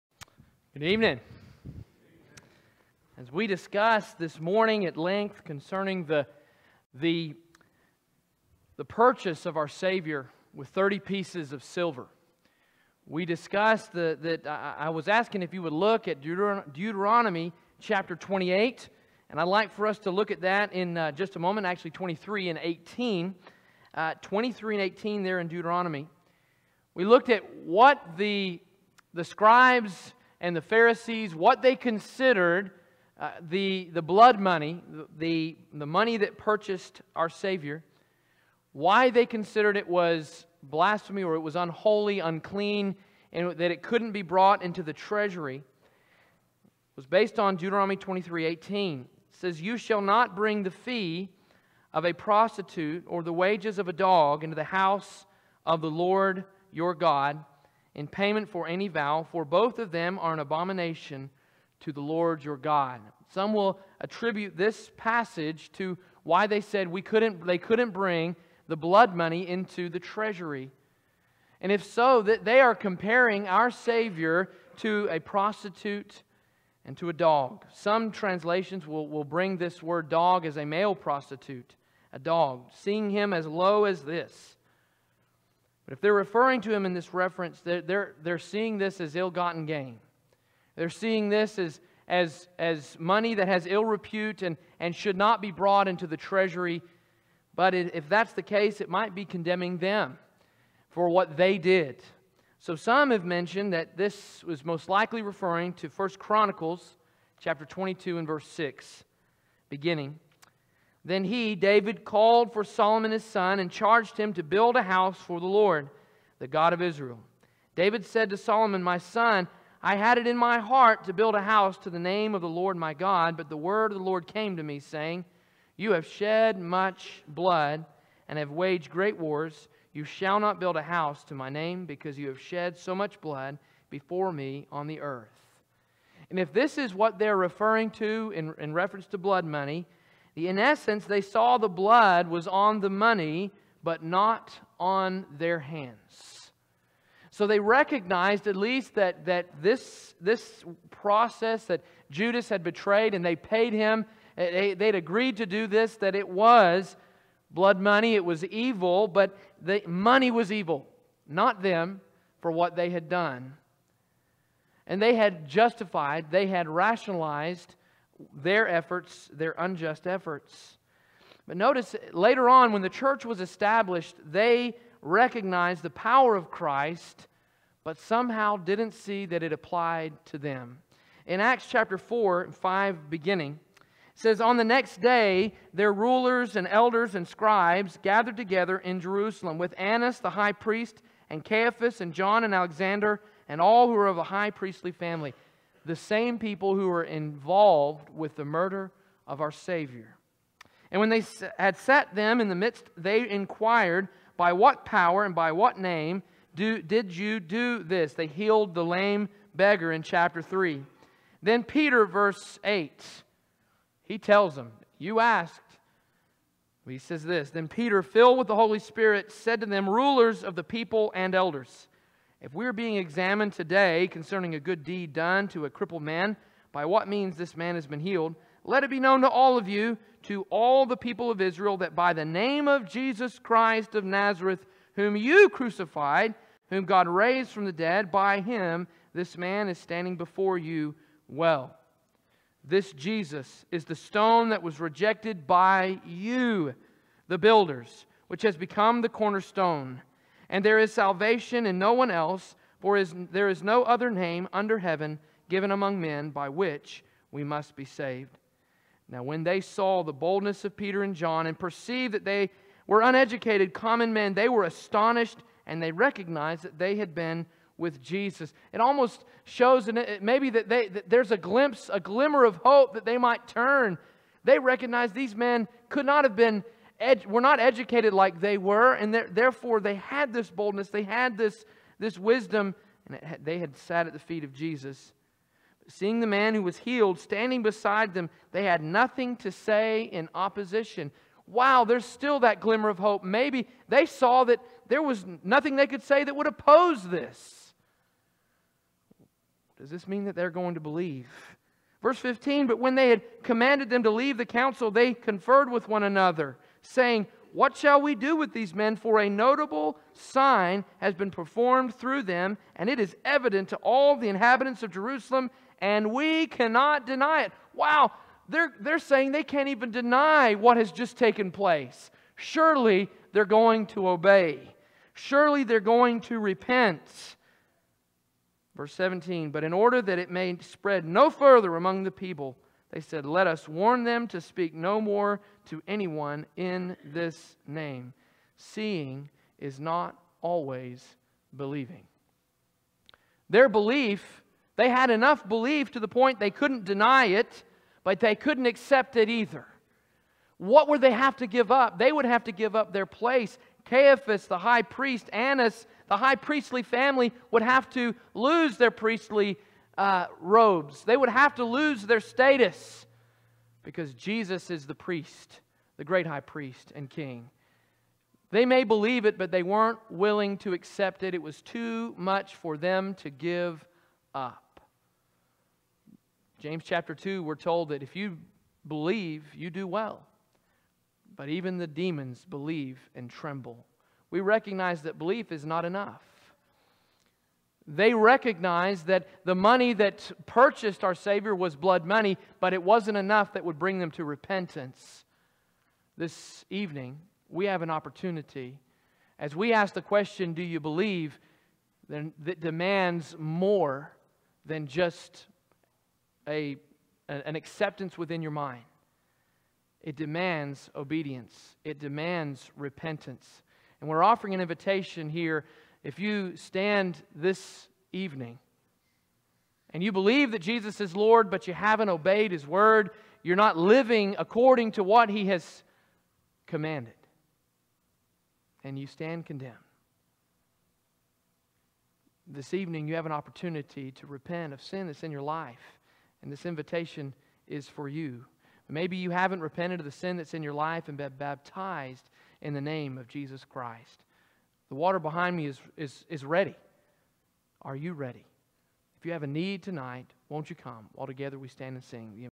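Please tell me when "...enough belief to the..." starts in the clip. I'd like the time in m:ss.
5:45.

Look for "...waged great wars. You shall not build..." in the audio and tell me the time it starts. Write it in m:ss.
2:08.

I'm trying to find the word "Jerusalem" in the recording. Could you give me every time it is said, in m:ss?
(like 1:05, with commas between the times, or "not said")
3:08, 5:14.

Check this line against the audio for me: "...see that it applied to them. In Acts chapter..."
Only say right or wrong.
right.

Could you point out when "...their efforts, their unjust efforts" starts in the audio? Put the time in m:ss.
2:48.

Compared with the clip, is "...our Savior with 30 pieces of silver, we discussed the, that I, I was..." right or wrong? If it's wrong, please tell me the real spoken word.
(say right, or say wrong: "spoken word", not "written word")
right.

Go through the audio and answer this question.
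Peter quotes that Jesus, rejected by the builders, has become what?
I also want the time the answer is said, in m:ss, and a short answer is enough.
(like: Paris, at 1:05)
the cornerstone, at 4:09.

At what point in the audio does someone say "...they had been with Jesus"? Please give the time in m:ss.
4:26.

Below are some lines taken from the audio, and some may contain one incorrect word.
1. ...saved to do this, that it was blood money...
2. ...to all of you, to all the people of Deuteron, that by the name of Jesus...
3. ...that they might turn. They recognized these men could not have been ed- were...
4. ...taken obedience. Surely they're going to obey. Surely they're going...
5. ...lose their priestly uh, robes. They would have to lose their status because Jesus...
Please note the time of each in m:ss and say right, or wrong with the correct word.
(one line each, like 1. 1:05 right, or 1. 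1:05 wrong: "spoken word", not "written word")
1. 2:34 wrong: "agreed", not "saved"
2. 3:49 wrong: "Israel", not "Deuteron"
3. 4:32 right
4. 5:21 wrong: "place", not "obedience"
5. 5:58 right.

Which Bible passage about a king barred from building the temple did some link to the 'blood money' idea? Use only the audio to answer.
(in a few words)
1 Chronicles 22:6.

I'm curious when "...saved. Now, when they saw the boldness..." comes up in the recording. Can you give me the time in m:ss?
4:17.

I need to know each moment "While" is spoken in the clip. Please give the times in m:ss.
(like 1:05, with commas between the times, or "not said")
7:31.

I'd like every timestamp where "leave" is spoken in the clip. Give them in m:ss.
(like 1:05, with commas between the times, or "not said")
5:04.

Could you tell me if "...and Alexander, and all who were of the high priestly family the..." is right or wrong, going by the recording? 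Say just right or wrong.
right.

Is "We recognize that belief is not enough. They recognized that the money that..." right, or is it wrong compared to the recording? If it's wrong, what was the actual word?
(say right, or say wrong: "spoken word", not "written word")
right.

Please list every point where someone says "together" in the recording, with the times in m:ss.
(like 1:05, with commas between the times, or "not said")
3:08, 7:31.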